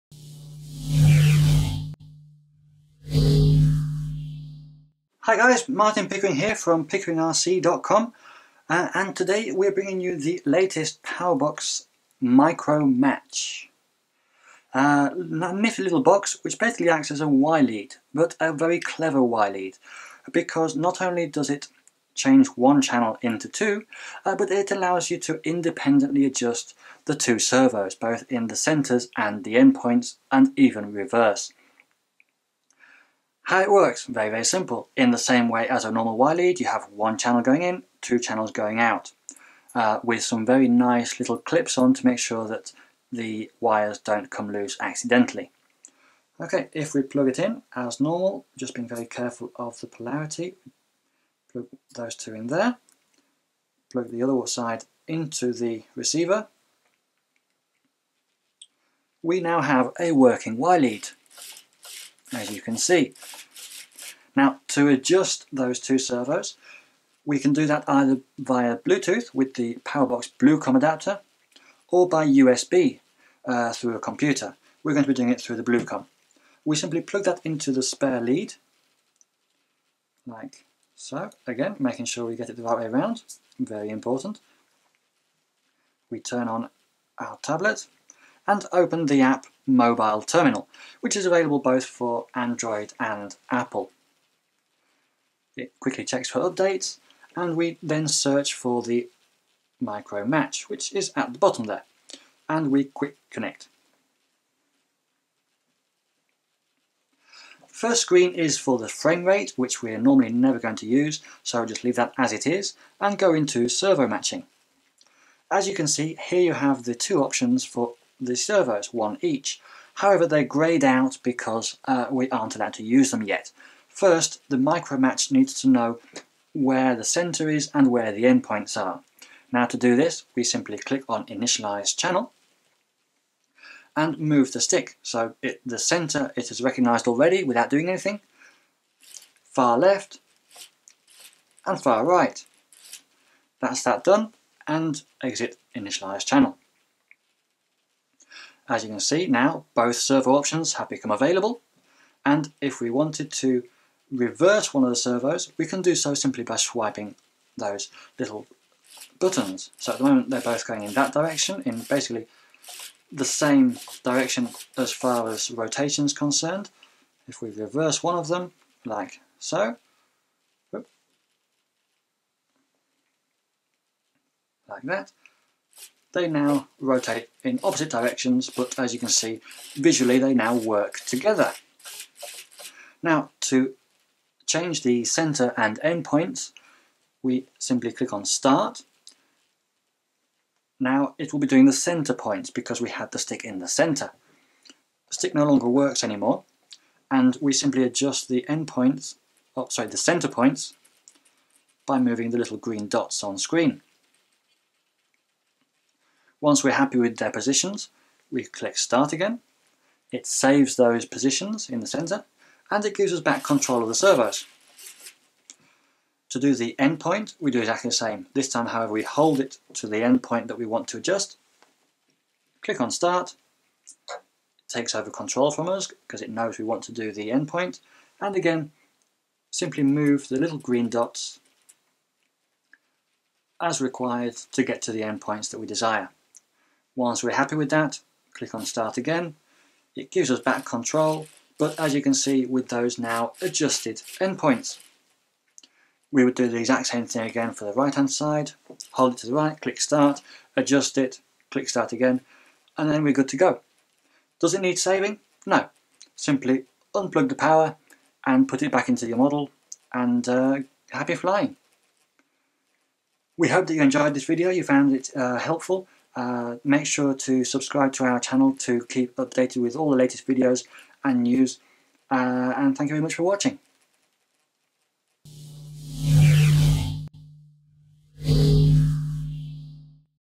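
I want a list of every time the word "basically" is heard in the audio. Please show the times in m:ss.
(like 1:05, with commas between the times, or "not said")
0:16, 2:41.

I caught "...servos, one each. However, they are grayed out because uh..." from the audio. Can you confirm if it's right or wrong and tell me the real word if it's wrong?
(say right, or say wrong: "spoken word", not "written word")
right.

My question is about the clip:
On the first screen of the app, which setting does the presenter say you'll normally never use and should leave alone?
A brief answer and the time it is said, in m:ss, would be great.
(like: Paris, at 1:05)
frame rate, at 1:48.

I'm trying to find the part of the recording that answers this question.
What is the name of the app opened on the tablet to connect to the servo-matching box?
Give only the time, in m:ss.
1:29.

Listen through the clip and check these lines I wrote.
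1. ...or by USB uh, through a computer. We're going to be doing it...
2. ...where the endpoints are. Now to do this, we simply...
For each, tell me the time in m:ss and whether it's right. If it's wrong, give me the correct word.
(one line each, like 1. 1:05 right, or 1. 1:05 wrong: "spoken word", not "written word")
1. 1:11 right
2. 2:07 right.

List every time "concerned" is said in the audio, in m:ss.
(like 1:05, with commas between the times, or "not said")
2:46.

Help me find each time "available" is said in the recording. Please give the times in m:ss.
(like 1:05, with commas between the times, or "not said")
1:31, 2:31.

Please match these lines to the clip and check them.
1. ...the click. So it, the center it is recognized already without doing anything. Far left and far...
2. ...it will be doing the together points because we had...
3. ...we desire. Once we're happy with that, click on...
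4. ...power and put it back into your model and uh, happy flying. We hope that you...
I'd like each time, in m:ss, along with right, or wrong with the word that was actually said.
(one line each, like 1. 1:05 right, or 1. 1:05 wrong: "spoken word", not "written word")
1. 2:14 wrong: "stick", not "click"
2. 3:11 wrong: "center", not "together"
3. 3:55 right
4. 4:17 right.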